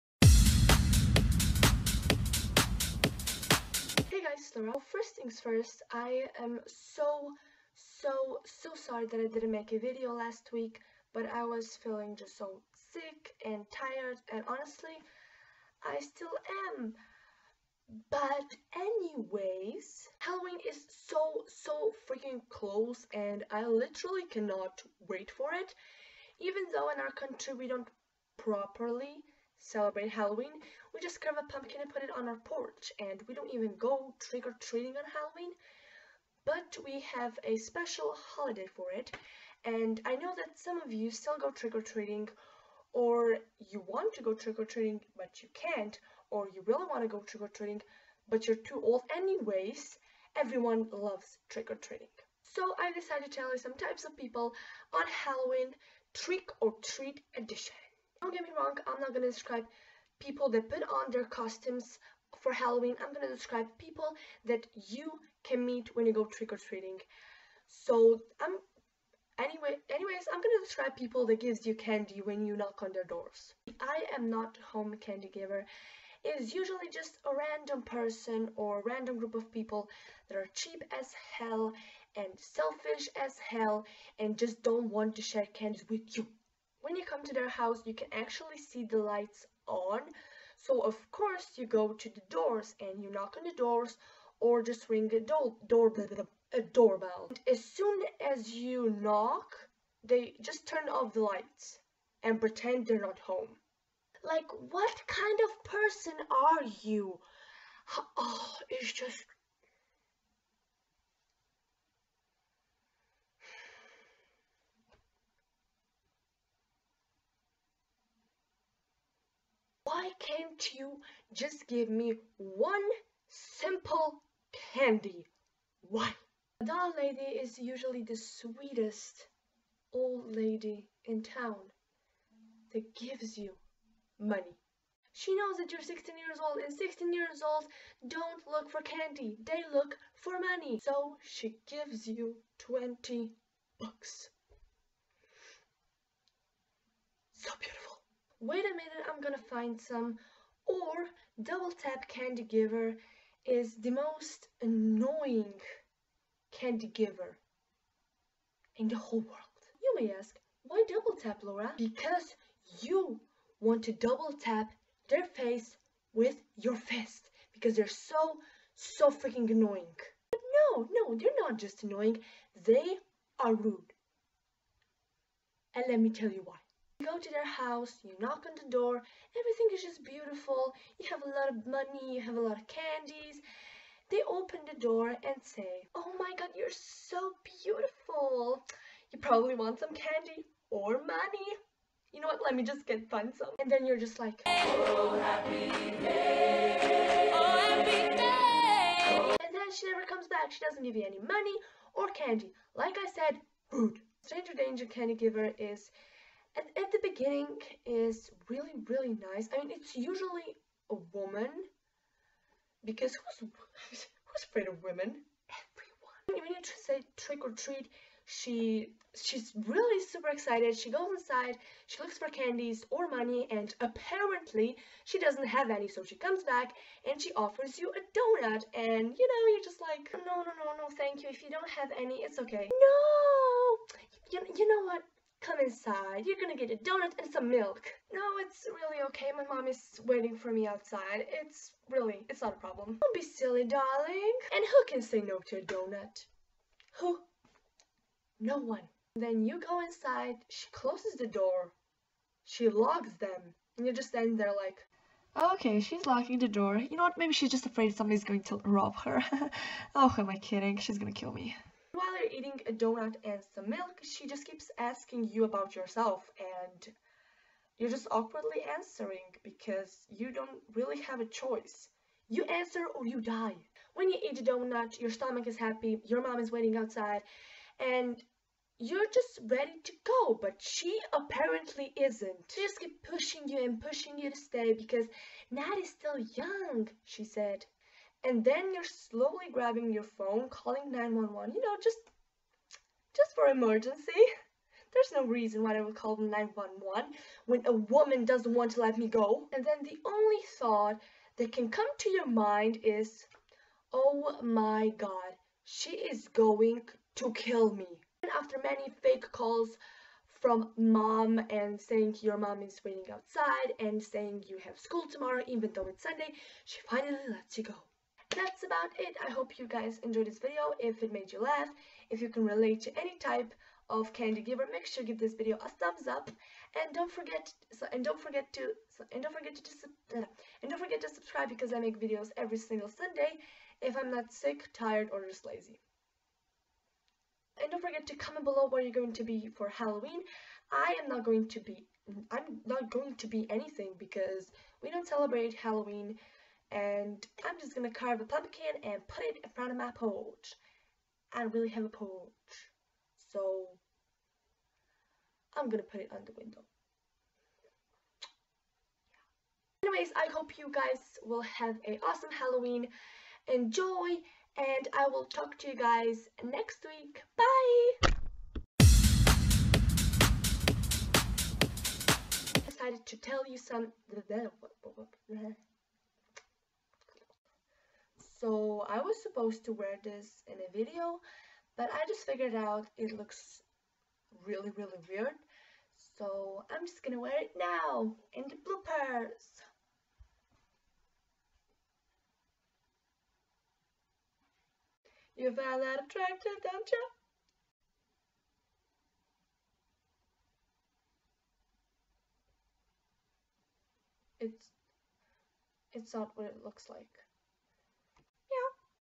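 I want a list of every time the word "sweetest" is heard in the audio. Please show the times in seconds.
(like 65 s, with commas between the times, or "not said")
128 s.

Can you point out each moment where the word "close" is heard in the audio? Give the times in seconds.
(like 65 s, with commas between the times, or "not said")
22 s, 250 s.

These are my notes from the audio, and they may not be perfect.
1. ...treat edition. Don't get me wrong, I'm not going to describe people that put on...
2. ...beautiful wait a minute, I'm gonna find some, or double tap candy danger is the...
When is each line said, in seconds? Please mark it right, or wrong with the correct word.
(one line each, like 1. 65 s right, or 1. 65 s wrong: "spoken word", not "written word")
1. 56 s right
2. 147 s wrong: "giver", not "danger".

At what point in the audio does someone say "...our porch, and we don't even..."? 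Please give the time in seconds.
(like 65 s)
32 s.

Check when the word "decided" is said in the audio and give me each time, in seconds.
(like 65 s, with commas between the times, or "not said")
52 s, 372 s.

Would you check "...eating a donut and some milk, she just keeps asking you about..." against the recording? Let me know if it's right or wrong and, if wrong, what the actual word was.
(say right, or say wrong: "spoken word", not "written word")
right.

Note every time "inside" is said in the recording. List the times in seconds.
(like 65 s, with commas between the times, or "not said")
221 s, 235 s, 249 s.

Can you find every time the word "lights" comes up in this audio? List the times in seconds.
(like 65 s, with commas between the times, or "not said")
88 s, 101 s.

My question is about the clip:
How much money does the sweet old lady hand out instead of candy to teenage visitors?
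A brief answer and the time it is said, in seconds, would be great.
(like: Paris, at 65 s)
$20, at 142 s.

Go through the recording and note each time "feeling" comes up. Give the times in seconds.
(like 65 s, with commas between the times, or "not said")
11 s.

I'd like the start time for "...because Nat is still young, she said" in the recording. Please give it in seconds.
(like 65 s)
284 s.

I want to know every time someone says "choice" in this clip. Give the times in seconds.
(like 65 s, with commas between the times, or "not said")
271 s.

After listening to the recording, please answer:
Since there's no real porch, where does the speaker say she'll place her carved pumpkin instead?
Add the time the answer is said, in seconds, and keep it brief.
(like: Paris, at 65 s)
On the window, at 356 s.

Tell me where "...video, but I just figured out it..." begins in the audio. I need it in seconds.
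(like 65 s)
380 s.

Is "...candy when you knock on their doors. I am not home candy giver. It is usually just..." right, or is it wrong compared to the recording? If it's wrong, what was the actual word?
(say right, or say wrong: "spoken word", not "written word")
right.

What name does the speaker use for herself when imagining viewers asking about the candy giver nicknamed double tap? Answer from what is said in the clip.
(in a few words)
Laura.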